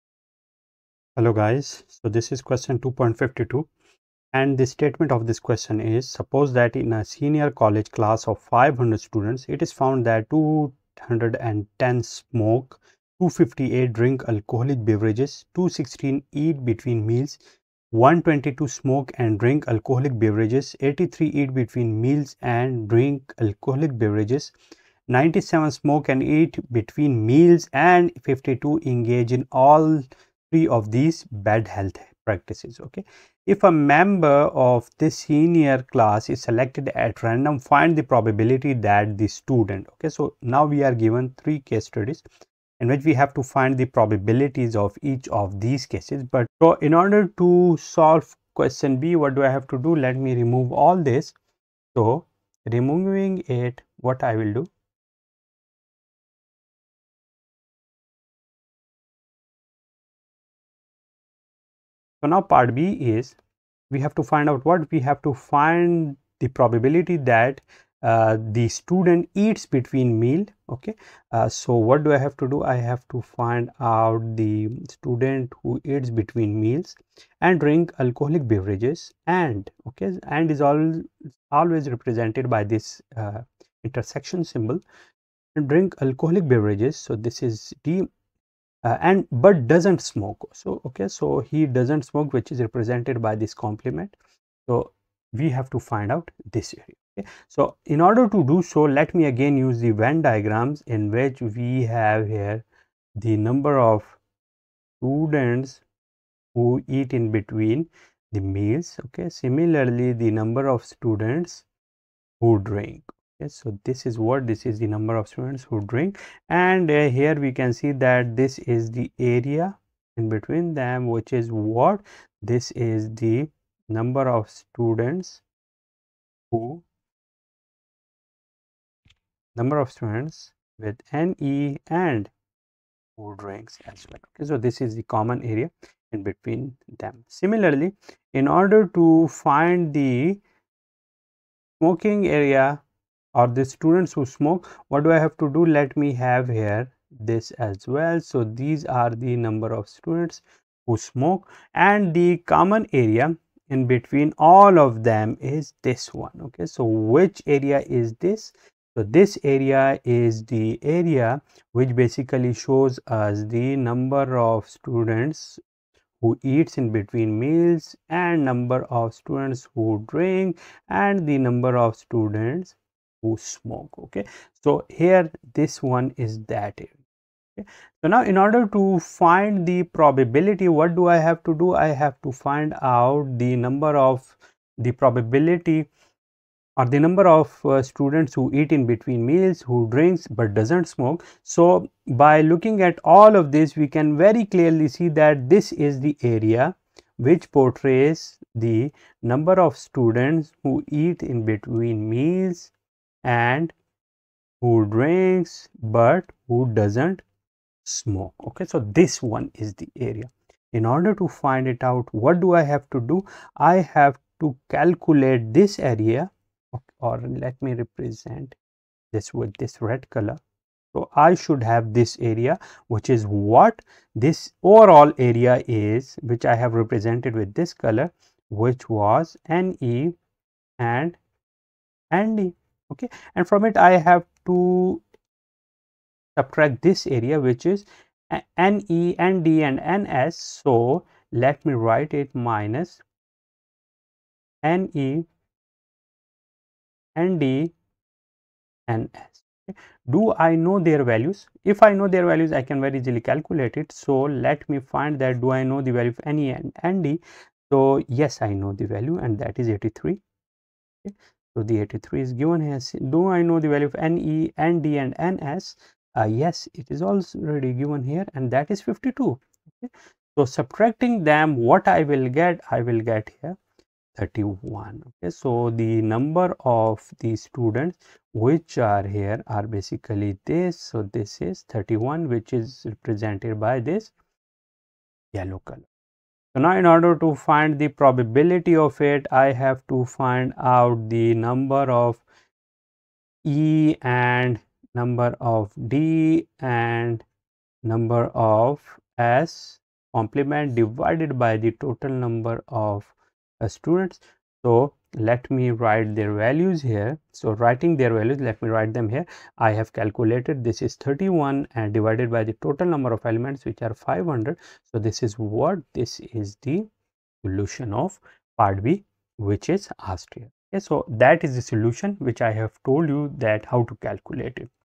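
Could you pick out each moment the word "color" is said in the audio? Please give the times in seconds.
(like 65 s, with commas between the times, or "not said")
220 s, 227 s, 285 s.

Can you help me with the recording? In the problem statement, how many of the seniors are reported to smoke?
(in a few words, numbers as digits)
210.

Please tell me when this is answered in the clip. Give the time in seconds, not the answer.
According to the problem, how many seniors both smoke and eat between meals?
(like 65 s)
25 s.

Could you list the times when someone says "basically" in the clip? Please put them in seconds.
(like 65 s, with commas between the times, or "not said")
161 s, 279 s.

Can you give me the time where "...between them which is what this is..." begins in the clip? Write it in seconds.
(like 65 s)
120 s.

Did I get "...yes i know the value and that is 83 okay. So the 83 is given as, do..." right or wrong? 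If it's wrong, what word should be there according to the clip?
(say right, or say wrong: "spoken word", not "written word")
right.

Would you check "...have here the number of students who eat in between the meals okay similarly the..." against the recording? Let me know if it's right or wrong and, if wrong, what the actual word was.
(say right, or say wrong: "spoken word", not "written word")
right.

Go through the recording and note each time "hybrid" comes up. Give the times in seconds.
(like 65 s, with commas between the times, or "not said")
not said.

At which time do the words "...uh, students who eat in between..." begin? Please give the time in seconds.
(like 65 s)
187 s.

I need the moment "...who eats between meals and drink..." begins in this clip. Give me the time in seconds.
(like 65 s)
75 s.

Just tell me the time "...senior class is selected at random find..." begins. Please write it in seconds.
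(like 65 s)
35 s.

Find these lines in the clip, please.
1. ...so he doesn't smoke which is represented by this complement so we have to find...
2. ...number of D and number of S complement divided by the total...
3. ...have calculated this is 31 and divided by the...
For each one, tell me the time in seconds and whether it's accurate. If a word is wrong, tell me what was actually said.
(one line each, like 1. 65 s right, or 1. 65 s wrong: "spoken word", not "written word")
1. 91 s right
2. 294 s right
3. 309 s right.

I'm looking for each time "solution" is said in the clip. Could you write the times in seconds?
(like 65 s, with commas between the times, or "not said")
317 s, 321 s.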